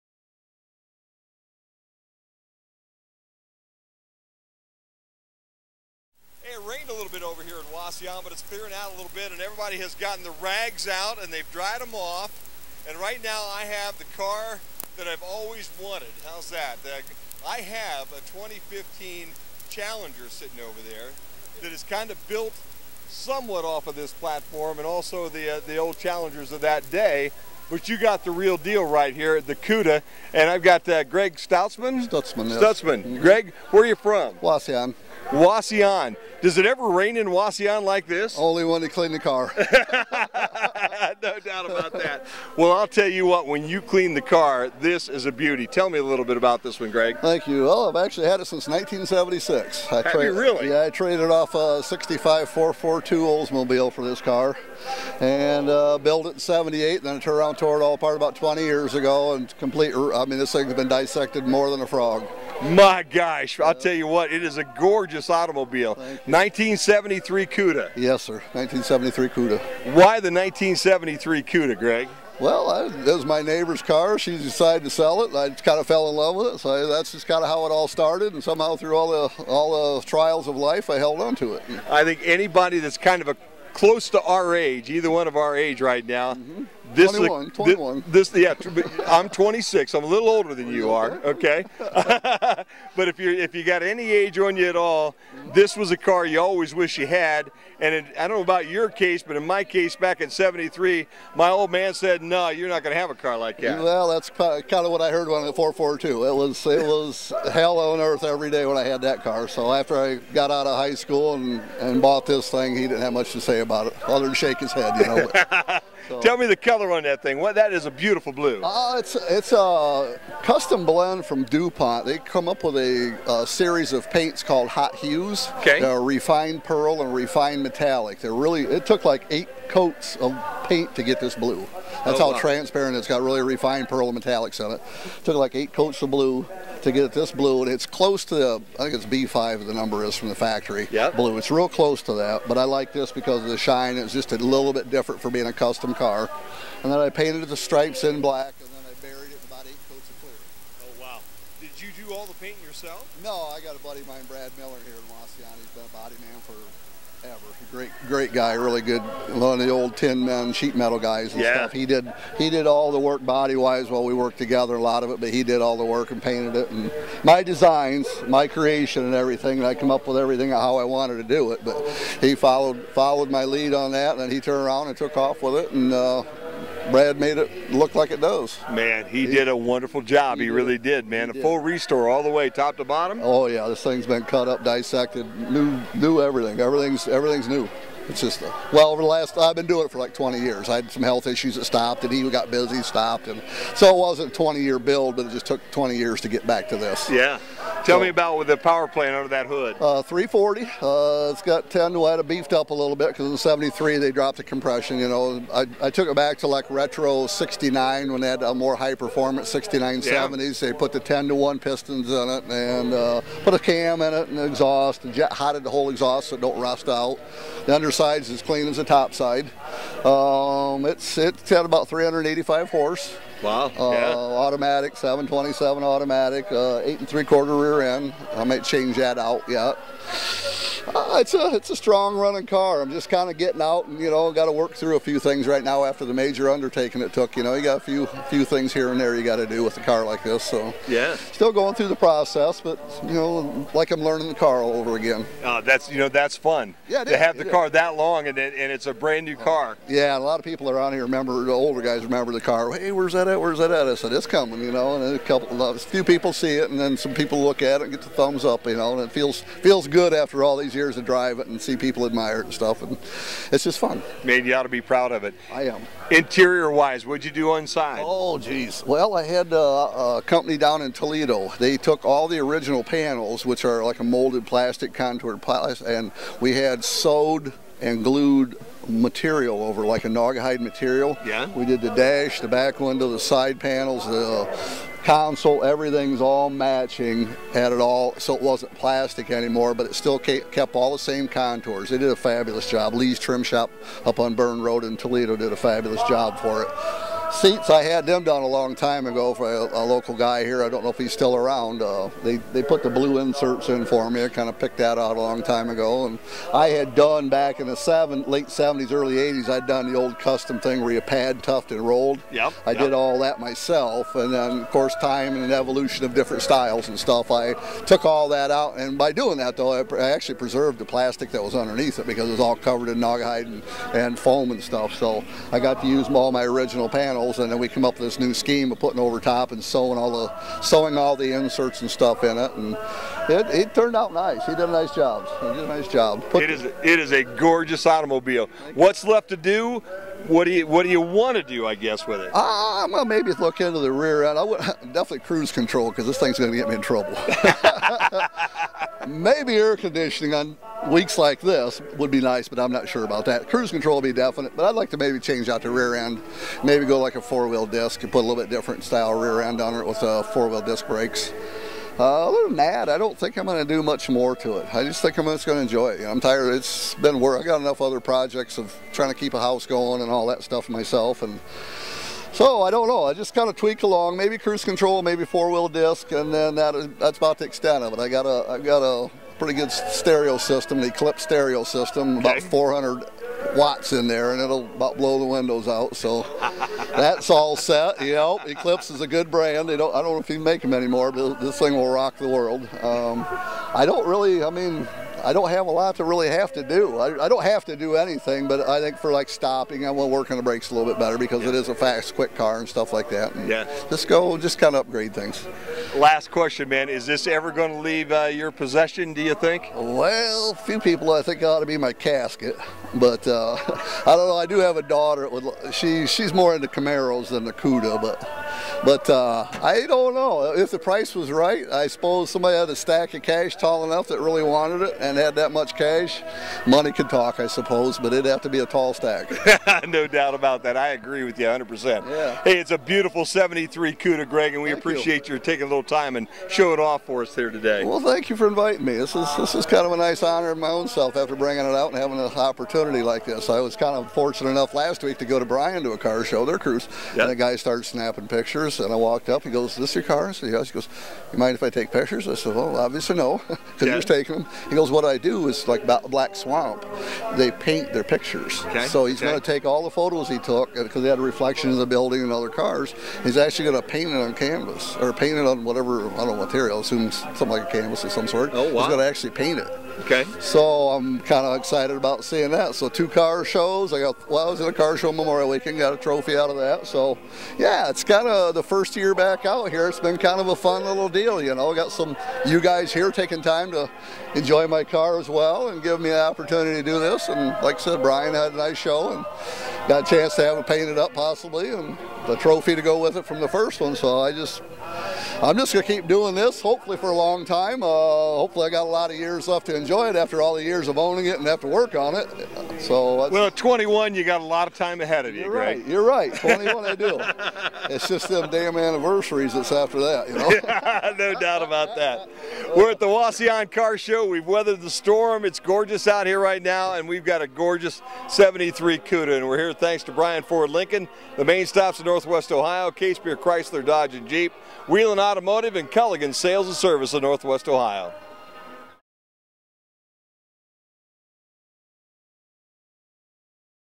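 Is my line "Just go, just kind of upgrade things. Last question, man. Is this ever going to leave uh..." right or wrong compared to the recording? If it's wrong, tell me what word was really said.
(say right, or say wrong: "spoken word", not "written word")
right.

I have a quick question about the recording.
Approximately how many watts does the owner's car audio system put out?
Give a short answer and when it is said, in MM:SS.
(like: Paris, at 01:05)
400, at 06:22.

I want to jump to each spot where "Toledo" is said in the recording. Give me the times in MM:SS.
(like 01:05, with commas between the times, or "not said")
04:30, 04:54.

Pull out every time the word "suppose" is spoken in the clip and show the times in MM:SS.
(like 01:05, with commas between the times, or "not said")
07:01, 07:07.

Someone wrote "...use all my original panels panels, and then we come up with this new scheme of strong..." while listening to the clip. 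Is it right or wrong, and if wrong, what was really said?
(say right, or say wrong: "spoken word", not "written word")
wrong: "putting", not "strong".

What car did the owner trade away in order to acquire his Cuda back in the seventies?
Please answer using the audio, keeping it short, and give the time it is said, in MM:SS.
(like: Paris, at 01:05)
1965 442 Oldsmobile, at 00:51.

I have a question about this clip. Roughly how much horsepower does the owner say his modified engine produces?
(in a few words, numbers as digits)
385.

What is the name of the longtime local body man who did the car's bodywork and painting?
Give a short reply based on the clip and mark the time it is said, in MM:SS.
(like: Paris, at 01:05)
Brad Miller, at 02:34.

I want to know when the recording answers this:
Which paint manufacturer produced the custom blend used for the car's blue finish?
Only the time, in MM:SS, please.
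02:01.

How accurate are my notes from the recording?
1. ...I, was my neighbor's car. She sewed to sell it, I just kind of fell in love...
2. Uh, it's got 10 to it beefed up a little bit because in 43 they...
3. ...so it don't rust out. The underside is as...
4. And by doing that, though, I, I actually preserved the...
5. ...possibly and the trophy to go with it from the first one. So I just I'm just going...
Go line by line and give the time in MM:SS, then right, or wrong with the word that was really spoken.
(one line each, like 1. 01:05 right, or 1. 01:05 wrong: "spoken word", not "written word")
1. 01:12 wrong: "decided", not "sewed"
2. 03:20 wrong: "73", not "43"
3. 03:36 right
4. 05:18 right
5. 08:11 right.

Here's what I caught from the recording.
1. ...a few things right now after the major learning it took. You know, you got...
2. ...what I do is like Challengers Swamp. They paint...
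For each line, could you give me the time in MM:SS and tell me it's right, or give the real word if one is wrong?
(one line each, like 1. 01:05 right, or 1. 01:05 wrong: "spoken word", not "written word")
1. 03:54 wrong: "undertaking", not "learning"
2. 07:34 wrong: "Black", not "Challengers".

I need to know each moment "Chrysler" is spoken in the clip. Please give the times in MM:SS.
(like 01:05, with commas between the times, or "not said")
08:43.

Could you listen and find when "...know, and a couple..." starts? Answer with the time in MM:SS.
04:14.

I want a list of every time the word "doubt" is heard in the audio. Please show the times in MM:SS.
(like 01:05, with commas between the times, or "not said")
00:41, 07:10, 08:31.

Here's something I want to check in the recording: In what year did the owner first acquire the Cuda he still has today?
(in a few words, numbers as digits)
1976.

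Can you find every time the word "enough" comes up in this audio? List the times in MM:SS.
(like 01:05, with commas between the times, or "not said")
06:07, 07:03, 07:24.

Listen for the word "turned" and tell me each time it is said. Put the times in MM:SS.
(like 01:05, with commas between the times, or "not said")
00:57, 02:54, 05:33.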